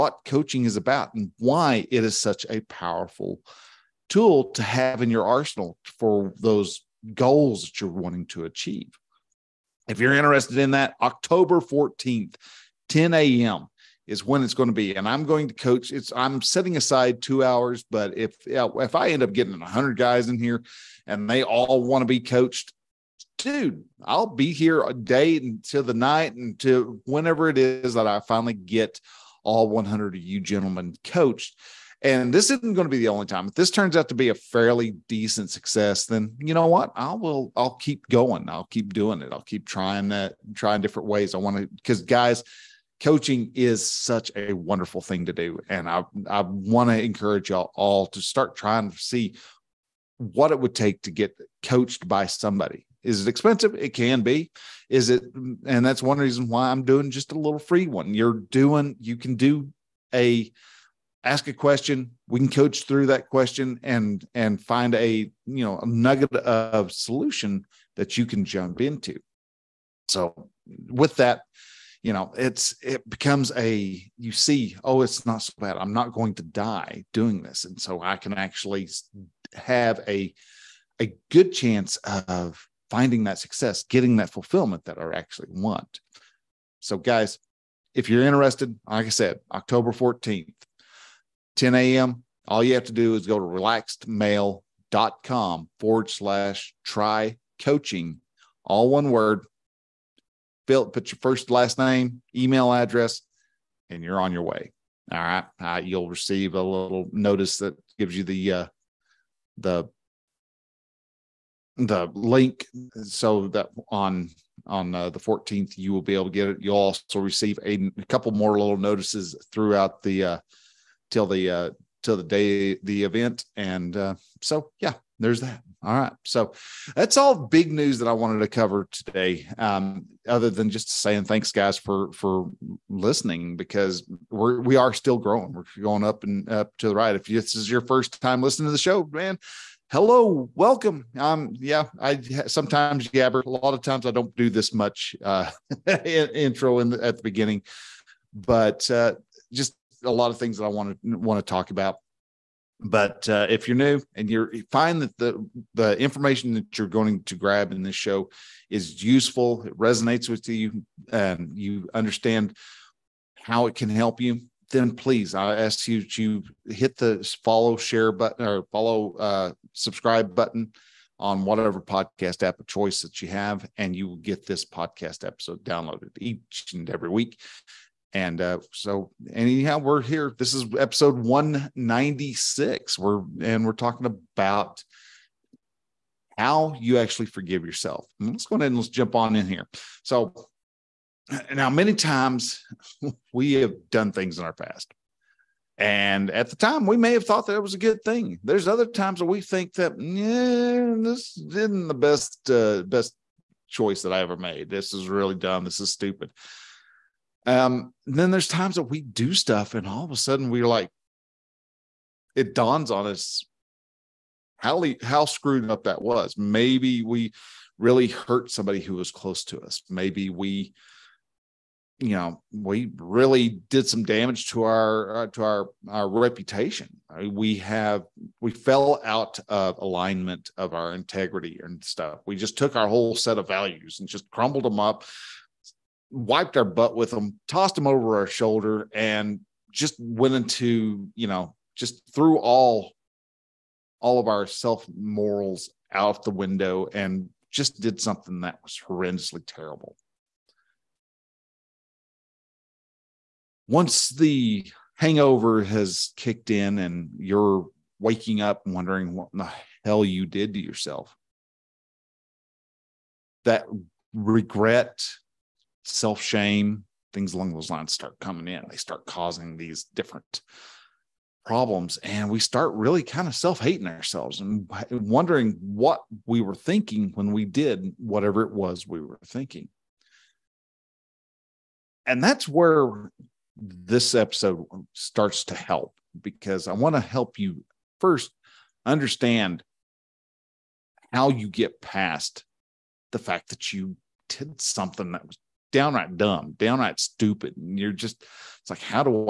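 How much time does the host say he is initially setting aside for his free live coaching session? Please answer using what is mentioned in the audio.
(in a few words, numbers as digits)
two hours.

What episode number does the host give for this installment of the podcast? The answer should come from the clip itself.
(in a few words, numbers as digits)
196.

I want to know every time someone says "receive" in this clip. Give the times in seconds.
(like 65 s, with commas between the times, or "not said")
106 s, 117 s.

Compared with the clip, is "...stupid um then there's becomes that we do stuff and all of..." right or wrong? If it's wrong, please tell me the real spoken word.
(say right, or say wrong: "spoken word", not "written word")
wrong: "times", not "becomes".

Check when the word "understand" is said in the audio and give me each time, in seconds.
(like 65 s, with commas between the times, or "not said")
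161 s, 288 s.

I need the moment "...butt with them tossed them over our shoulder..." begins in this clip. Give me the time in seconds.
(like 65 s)
236 s.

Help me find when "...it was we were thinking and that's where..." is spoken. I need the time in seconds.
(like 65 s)
278 s.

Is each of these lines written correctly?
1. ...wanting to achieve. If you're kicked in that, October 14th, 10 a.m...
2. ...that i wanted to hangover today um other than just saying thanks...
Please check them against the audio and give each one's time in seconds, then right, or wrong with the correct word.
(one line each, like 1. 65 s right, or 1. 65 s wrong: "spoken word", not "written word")
1. 7 s wrong: "interested", not "kicked"
2. 127 s wrong: "cover", not "hangover".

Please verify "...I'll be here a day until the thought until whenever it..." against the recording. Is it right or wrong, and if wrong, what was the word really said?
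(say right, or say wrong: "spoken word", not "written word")
wrong: "night", not "thought".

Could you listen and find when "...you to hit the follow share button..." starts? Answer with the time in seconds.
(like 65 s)
165 s.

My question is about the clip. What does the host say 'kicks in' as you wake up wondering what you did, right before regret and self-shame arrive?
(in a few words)
the hangover.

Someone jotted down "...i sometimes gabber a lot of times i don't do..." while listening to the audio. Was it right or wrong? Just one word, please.
right.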